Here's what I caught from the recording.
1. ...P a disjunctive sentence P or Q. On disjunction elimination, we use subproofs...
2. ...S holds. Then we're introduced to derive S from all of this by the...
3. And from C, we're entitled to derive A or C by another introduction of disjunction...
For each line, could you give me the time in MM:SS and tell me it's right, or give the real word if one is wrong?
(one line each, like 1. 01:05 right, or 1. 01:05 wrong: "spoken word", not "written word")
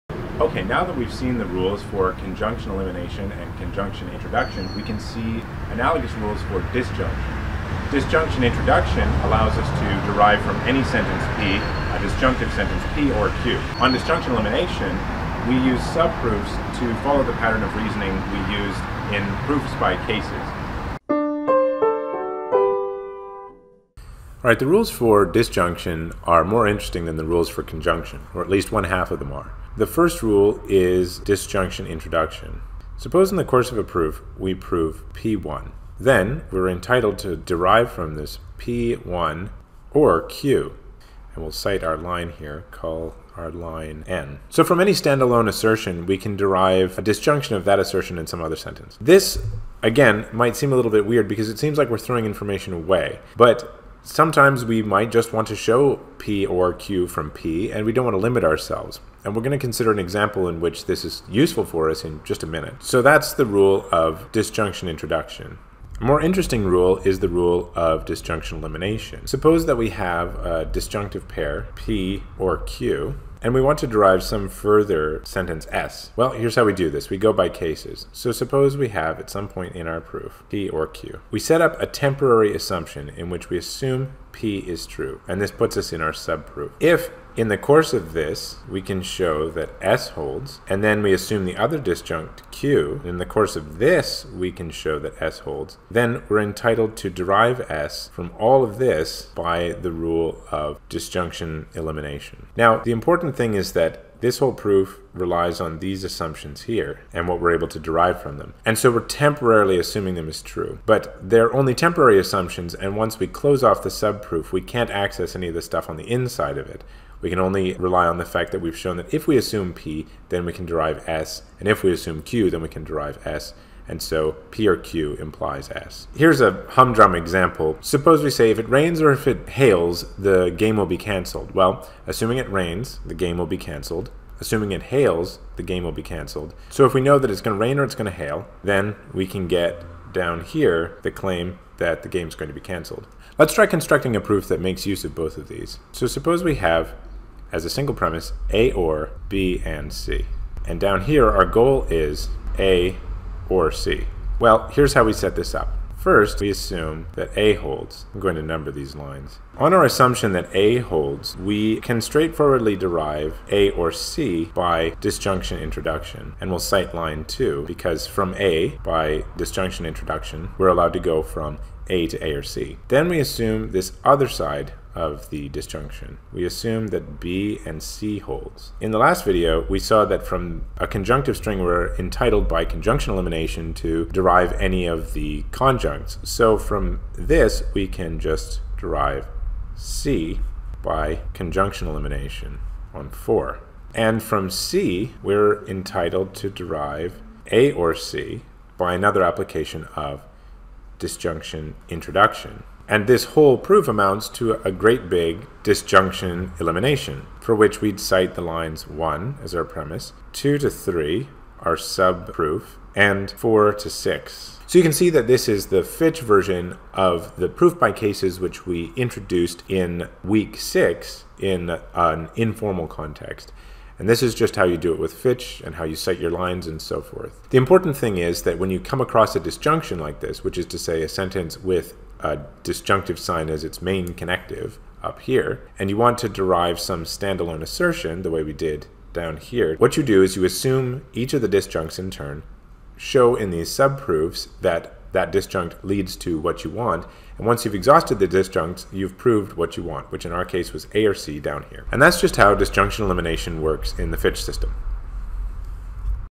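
1. 00:11 right
2. 01:35 wrong: "entitled", not "introduced"
3. 03:13 wrong: "application", not "introduction".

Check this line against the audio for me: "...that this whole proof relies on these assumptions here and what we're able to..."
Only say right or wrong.
right.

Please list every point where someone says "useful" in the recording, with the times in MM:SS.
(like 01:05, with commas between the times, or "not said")
01:01.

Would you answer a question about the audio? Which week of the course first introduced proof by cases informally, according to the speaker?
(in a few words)
Week 6.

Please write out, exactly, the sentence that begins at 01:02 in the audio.
So that's the rule of disjunction introduction.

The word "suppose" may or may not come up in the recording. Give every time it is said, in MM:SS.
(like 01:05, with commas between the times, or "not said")
00:32, 01:09, 01:18, 02:07, 02:26.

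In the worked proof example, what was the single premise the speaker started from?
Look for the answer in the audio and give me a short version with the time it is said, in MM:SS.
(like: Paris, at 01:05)
A or B and C, at 02:28.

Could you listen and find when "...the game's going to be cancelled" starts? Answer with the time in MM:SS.
02:22.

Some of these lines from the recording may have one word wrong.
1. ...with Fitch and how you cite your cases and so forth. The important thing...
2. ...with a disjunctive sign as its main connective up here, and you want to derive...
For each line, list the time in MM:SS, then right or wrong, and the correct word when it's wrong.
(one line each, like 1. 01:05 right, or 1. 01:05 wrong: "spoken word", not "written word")
1. 03:44 wrong: "lines", not "cases"
2. 03:51 right.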